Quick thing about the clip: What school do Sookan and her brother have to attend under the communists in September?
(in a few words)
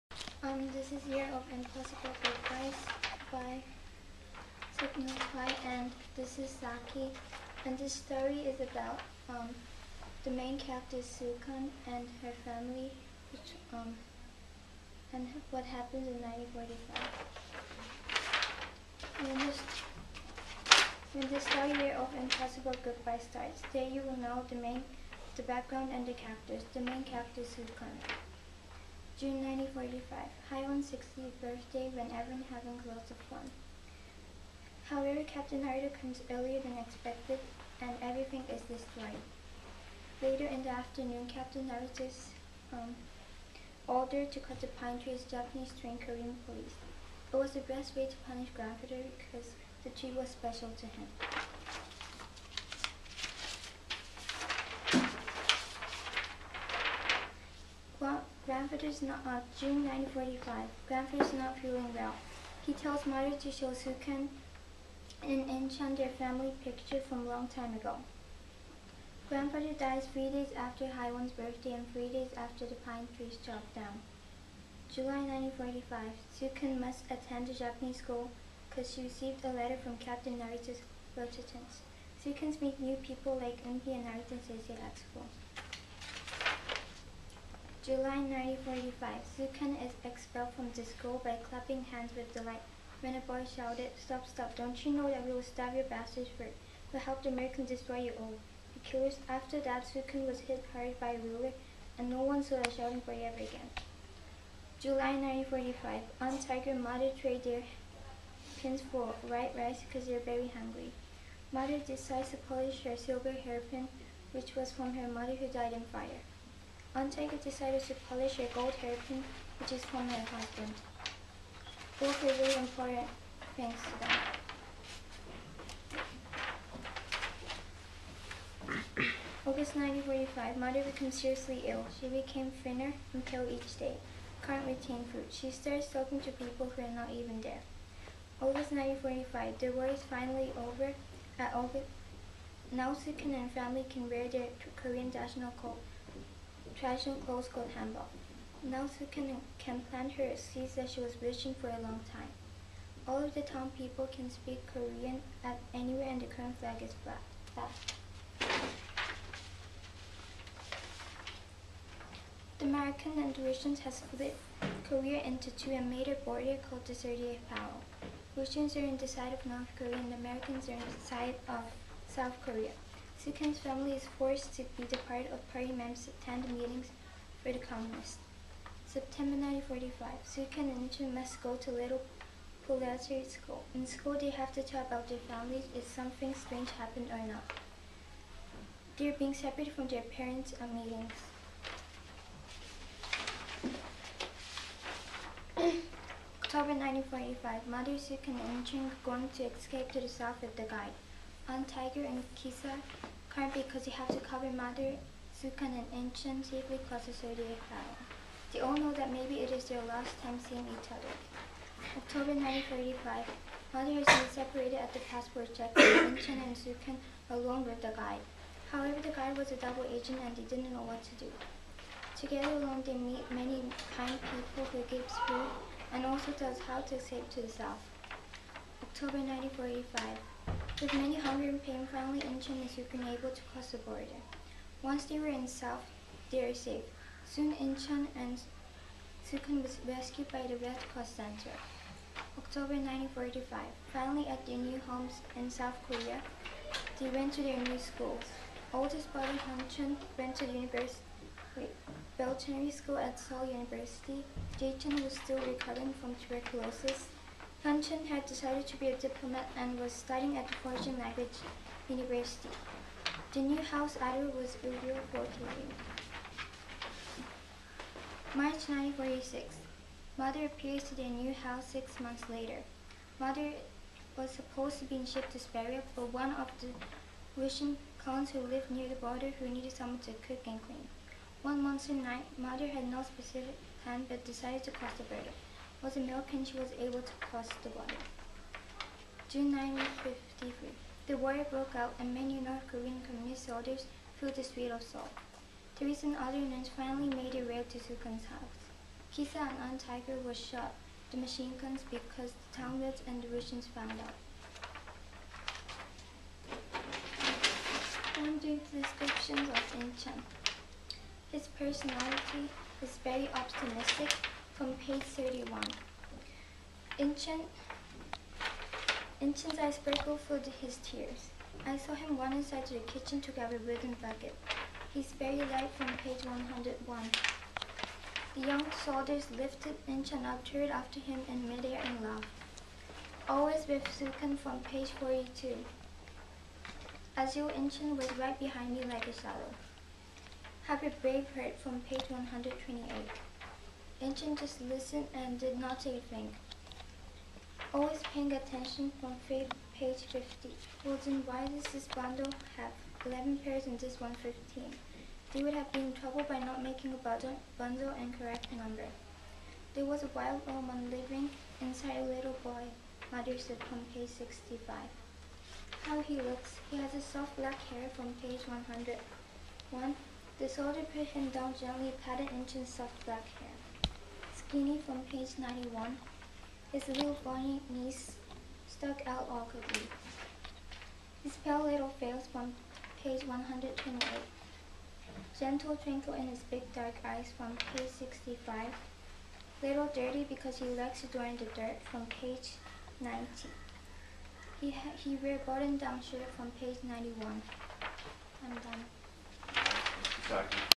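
Little Proletariat School.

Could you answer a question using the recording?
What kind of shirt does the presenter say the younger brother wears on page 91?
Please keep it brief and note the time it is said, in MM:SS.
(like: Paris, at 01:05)
button-down shirt, at 06:35.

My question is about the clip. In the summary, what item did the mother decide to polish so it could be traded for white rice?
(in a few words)
silver hairpin.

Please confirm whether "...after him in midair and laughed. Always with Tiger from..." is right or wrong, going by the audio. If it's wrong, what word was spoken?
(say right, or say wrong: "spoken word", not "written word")
wrong: "Sookan", not "Tiger".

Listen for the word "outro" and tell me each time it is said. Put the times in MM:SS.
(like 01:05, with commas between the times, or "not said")
not said.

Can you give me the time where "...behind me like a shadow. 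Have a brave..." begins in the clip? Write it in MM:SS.
05:38.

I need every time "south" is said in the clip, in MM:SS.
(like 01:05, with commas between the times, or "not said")
02:52, 03:20, 03:47, 03:55, 04:05.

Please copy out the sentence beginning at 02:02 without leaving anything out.
Both are very important things to them.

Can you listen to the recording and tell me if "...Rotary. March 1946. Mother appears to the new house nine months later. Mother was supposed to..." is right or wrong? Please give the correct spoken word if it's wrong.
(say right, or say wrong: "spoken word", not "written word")
wrong: "six", not "nine".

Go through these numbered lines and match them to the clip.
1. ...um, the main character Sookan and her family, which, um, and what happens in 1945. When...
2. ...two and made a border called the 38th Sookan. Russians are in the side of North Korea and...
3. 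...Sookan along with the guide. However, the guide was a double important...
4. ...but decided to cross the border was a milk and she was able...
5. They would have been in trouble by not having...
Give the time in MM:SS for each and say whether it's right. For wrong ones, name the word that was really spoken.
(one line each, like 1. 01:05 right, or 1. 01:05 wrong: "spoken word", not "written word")
1. 00:09 right
2. 02:45 wrong: "Parallel", not "Sookan"
3. 03:36 wrong: "agent", not "important"
4. 04:44 right
5. 05:55 wrong: "making", not "having".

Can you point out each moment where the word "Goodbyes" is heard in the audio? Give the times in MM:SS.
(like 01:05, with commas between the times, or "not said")
00:02, 00:22.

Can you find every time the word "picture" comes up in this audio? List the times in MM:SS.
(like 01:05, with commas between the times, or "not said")
01:06.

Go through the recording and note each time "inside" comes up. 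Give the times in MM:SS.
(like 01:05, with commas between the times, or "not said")
05:22, 06:01.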